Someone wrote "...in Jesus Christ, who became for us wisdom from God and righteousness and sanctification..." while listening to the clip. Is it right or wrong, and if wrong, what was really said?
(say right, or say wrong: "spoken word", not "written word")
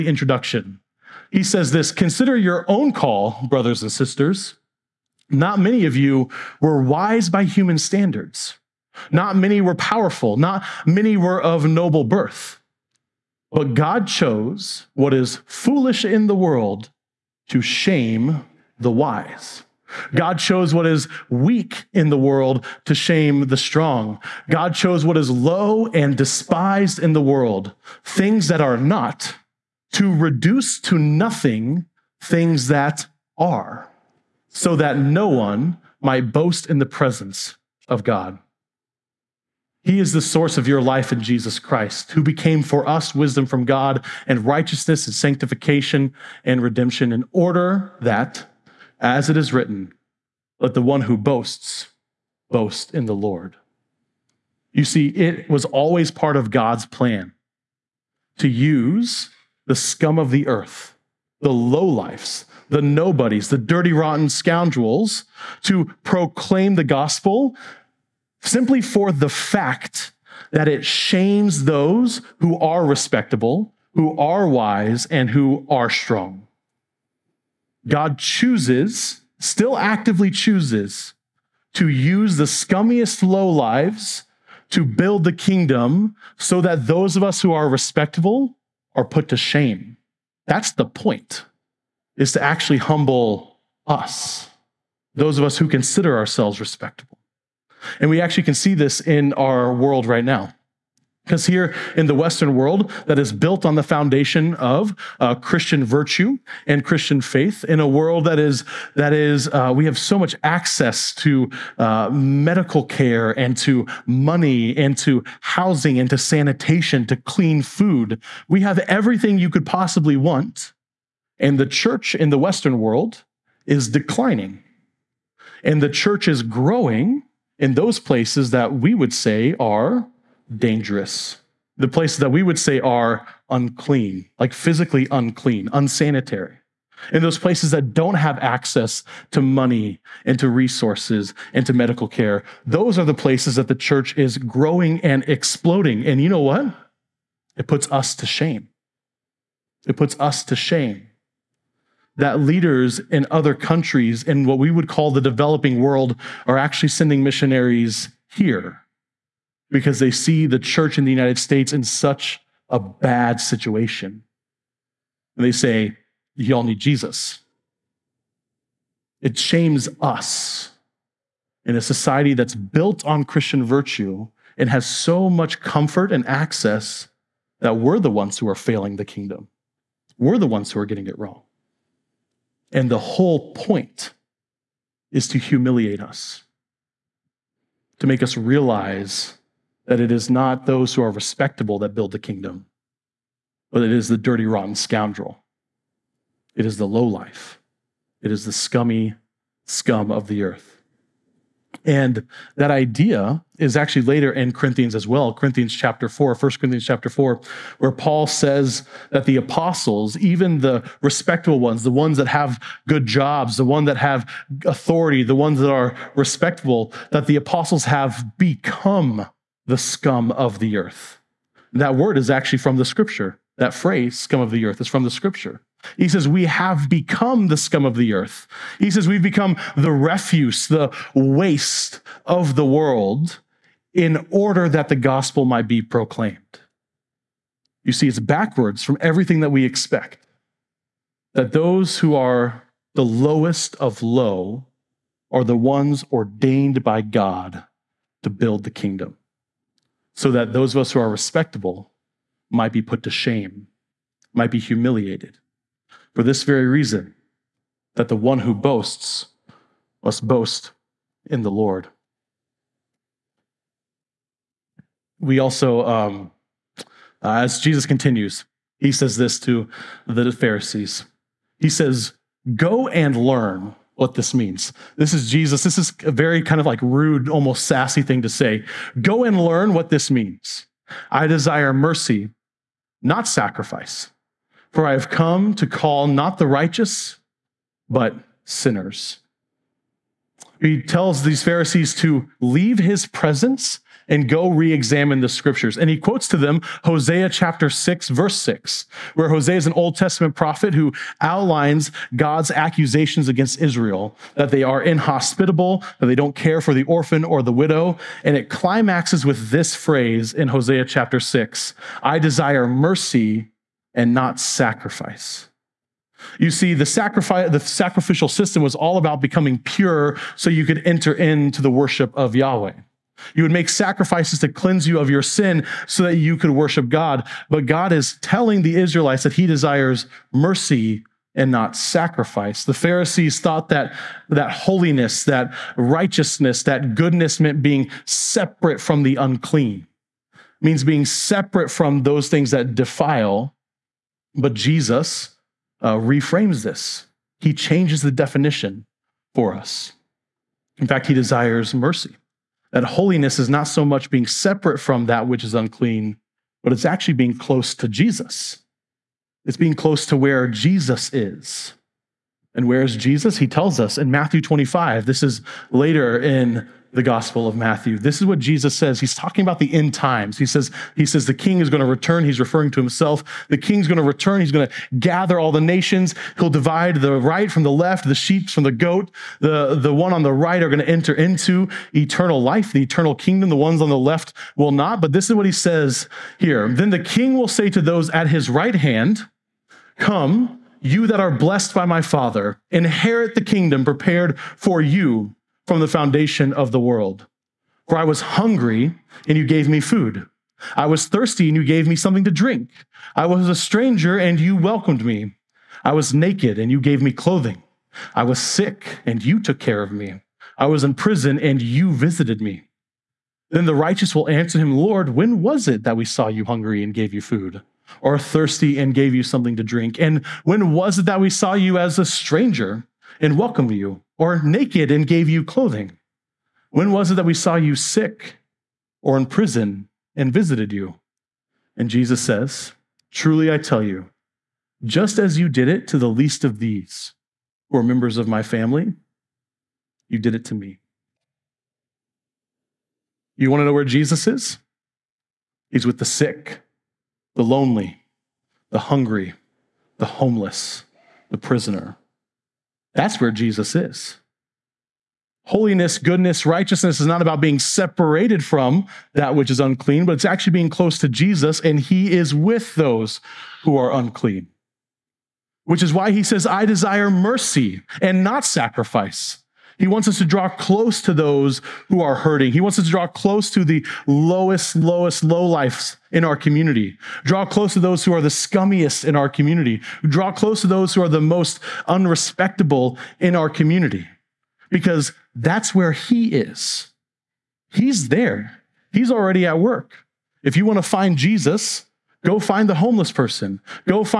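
right.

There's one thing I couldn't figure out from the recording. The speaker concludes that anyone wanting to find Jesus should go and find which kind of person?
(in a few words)
The homeless person.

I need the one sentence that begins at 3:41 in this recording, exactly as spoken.
That word is actually from the scripture.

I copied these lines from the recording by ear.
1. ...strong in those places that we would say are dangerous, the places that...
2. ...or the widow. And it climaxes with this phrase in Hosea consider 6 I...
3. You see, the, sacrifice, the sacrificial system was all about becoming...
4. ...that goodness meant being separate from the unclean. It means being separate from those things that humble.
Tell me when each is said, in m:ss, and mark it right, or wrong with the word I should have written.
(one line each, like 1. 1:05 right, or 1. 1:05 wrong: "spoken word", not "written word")
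1. 2:06 wrong: "growing", not "strong"
2. 5:07 wrong: "chapter", not "consider"
3. 5:16 right
4. 5:36 wrong: "defile", not "humble".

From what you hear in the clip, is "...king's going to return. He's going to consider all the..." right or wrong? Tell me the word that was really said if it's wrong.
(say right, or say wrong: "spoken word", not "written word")
wrong: "gather", not "consider".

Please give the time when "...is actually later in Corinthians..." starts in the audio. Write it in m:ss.
3:23.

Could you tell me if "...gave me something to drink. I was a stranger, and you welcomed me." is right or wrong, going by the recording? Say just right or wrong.
right.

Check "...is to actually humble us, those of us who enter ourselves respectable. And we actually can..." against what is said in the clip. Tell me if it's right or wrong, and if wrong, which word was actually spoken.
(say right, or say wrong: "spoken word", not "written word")
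wrong: "consider", not "enter".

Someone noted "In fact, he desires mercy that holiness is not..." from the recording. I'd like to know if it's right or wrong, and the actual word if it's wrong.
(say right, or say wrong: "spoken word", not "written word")
right.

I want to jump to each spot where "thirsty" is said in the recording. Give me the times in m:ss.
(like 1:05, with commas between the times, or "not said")
6:41, 6:58.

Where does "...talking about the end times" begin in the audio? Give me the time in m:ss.
6:09.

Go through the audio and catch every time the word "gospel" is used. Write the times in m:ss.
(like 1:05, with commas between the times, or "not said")
1:06, 3:54, 6:07.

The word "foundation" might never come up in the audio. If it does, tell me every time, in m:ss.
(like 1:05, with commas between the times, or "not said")
1:43, 6:35.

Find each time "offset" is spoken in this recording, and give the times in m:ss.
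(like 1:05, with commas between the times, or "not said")
not said.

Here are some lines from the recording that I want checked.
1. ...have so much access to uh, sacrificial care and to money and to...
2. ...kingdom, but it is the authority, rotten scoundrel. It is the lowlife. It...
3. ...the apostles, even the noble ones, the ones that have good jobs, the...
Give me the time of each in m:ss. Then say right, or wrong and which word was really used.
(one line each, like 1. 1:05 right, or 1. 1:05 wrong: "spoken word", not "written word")
1. 1:49 wrong: "medical", not "sacrificial"
2. 3:12 wrong: "dirty", not "authority"
3. 3:29 wrong: "respectable", not "noble".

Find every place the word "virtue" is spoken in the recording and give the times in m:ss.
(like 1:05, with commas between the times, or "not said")
1:45, 2:53.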